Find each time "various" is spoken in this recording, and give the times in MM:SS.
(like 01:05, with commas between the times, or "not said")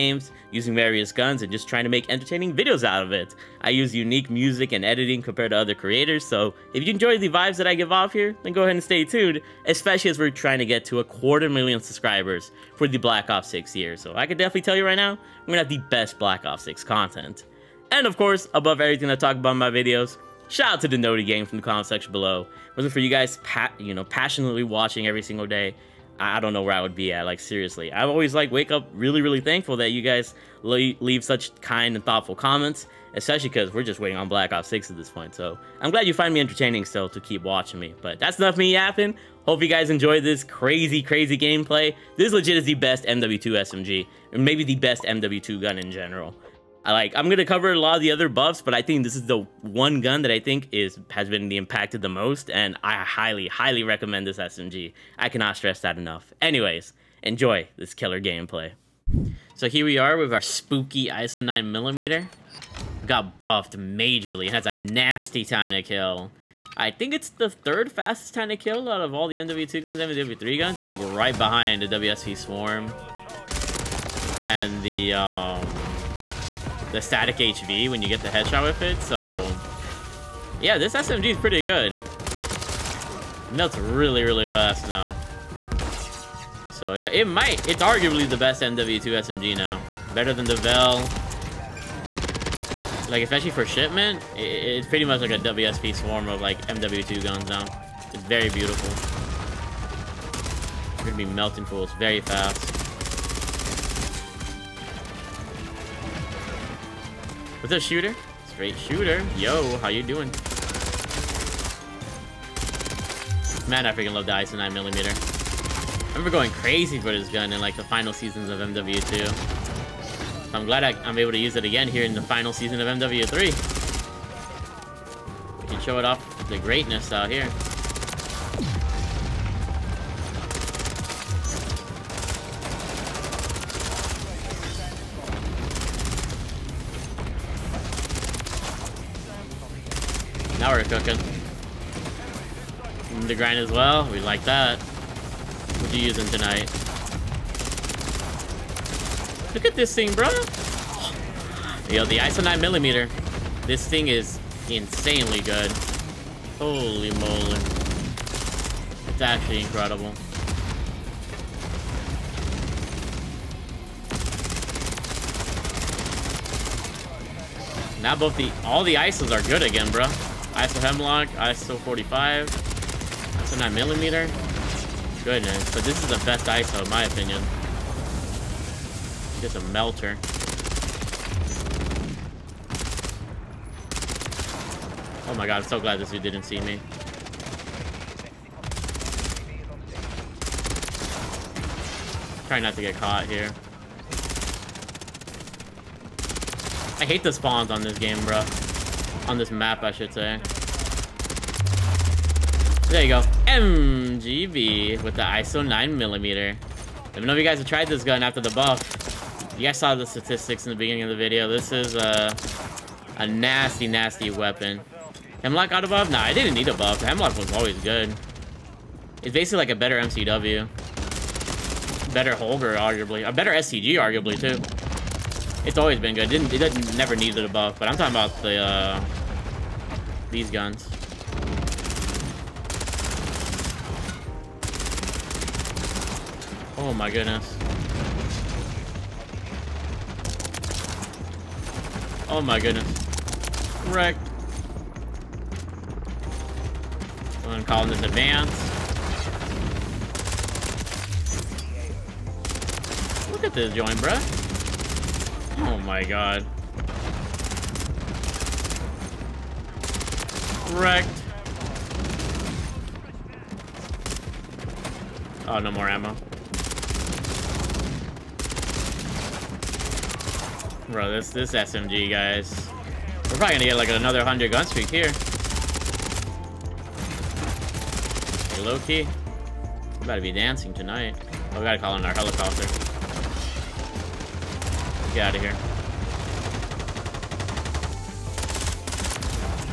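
00:00.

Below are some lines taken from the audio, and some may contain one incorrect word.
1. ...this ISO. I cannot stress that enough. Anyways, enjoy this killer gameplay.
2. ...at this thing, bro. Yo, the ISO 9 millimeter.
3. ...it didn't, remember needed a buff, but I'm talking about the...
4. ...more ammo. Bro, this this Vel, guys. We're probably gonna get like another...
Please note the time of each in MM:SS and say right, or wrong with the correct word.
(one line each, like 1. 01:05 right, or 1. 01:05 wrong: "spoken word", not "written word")
1. 00:54 wrong: "SMG", not "ISO"
2. 02:29 right
3. 03:46 wrong: "never", not "remember"
4. 04:25 wrong: "SMG", not "Vel".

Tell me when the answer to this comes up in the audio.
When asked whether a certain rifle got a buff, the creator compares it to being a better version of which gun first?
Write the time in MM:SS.
03:40.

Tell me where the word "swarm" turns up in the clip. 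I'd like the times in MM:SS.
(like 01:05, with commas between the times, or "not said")
01:12, 01:35.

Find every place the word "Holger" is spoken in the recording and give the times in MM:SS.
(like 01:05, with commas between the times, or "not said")
03:42.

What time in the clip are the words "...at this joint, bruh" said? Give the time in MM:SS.
04:13.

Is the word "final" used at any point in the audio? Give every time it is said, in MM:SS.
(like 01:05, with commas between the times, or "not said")
01:57, 02:02.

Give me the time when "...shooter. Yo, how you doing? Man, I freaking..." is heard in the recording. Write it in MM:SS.
01:48.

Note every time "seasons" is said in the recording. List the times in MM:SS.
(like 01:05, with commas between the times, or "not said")
01:58, 02:02.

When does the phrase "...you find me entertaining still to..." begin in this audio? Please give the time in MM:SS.
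00:36.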